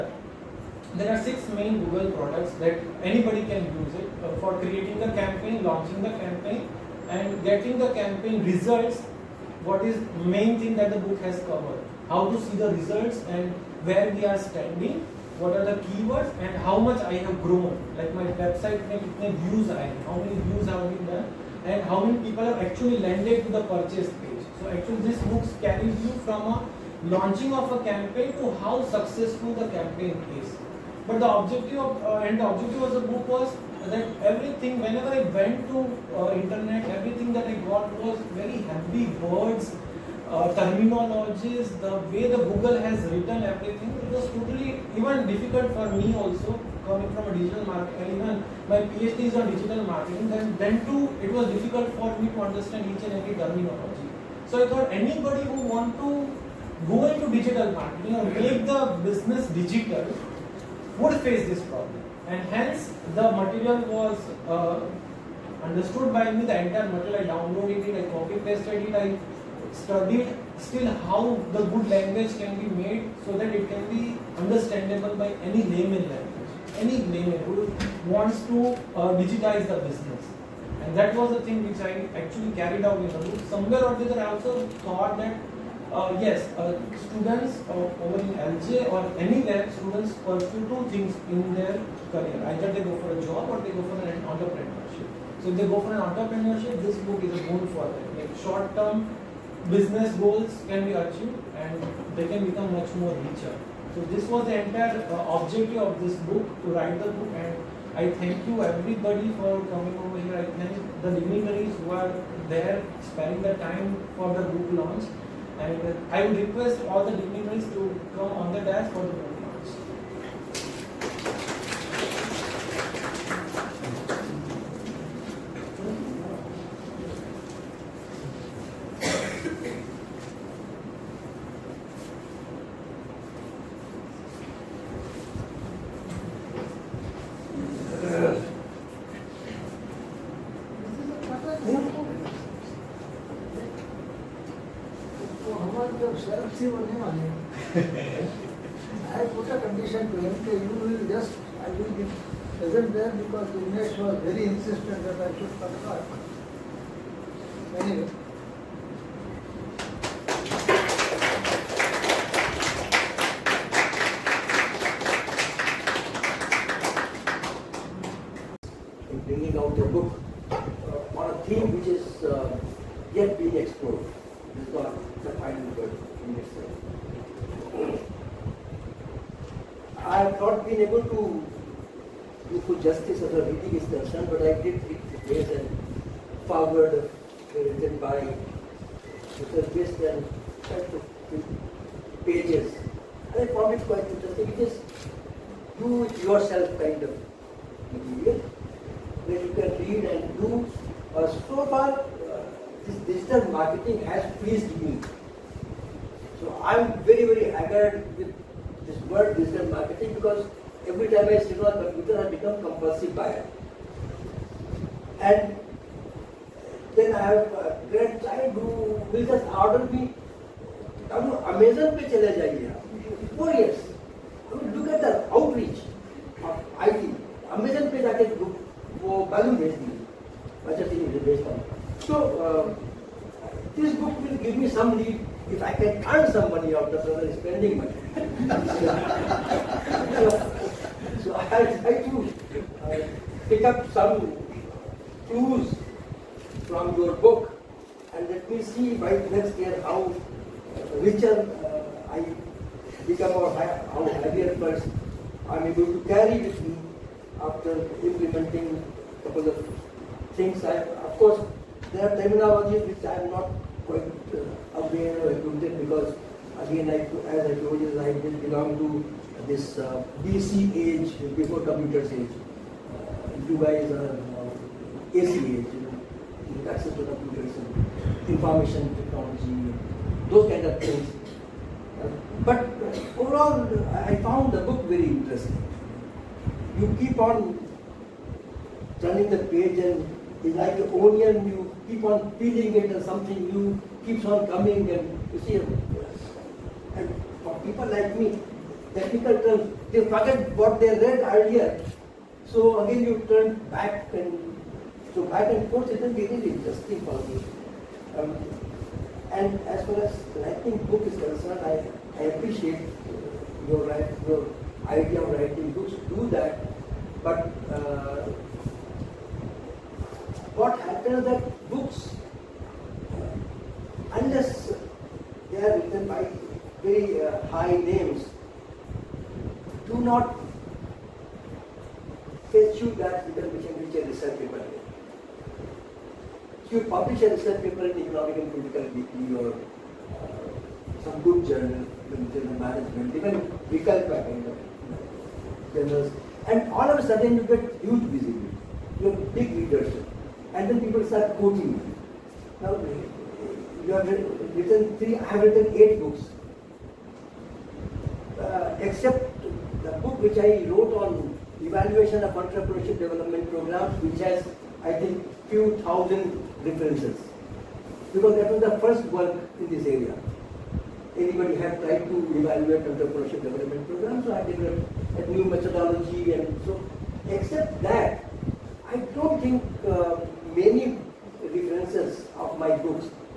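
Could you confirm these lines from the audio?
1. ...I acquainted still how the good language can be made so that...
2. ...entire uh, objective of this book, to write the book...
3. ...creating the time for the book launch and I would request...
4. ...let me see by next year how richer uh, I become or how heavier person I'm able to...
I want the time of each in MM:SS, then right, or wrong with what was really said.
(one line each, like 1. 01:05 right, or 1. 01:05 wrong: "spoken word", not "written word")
1. 01:08 wrong: "studied", not "acquainted"
2. 01:44 right
3. 01:53 wrong: "sparing", not "creating"
4. 04:08 right.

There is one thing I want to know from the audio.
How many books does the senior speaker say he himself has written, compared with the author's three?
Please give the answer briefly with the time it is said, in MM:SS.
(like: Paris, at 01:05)
8, at 05:55.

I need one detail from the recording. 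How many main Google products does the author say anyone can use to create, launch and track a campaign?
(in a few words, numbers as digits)
6.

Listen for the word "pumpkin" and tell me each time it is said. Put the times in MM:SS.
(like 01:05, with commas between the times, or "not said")
not said.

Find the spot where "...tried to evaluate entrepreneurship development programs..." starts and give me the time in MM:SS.
06:11.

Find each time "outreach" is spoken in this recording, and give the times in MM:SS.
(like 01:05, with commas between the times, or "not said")
03:45.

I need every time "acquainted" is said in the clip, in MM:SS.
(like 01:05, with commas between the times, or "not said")
04:25.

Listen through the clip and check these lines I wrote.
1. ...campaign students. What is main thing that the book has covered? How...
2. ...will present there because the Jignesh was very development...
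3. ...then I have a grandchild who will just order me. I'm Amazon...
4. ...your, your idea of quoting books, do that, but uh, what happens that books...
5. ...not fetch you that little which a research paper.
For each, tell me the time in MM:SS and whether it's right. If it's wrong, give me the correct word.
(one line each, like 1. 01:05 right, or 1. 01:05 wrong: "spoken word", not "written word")
1. 00:07 wrong: "results", not "students"
2. 02:31 wrong: "insistent", not "development"
3. 03:36 right
4. 05:13 wrong: "writing", not "quoting"
5. 05:30 right.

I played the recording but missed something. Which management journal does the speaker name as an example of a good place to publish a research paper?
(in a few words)
Vikalpa.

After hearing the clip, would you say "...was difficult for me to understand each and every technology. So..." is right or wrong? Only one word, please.
wrong.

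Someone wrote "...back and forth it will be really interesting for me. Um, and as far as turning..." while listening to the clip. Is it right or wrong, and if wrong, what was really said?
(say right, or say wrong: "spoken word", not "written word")
wrong: "writing", not "turning".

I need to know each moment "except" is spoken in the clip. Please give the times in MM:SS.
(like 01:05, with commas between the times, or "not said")
05:58, 06:17.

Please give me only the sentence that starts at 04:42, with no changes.
Uh, but uh, overall, I found the book very interesting.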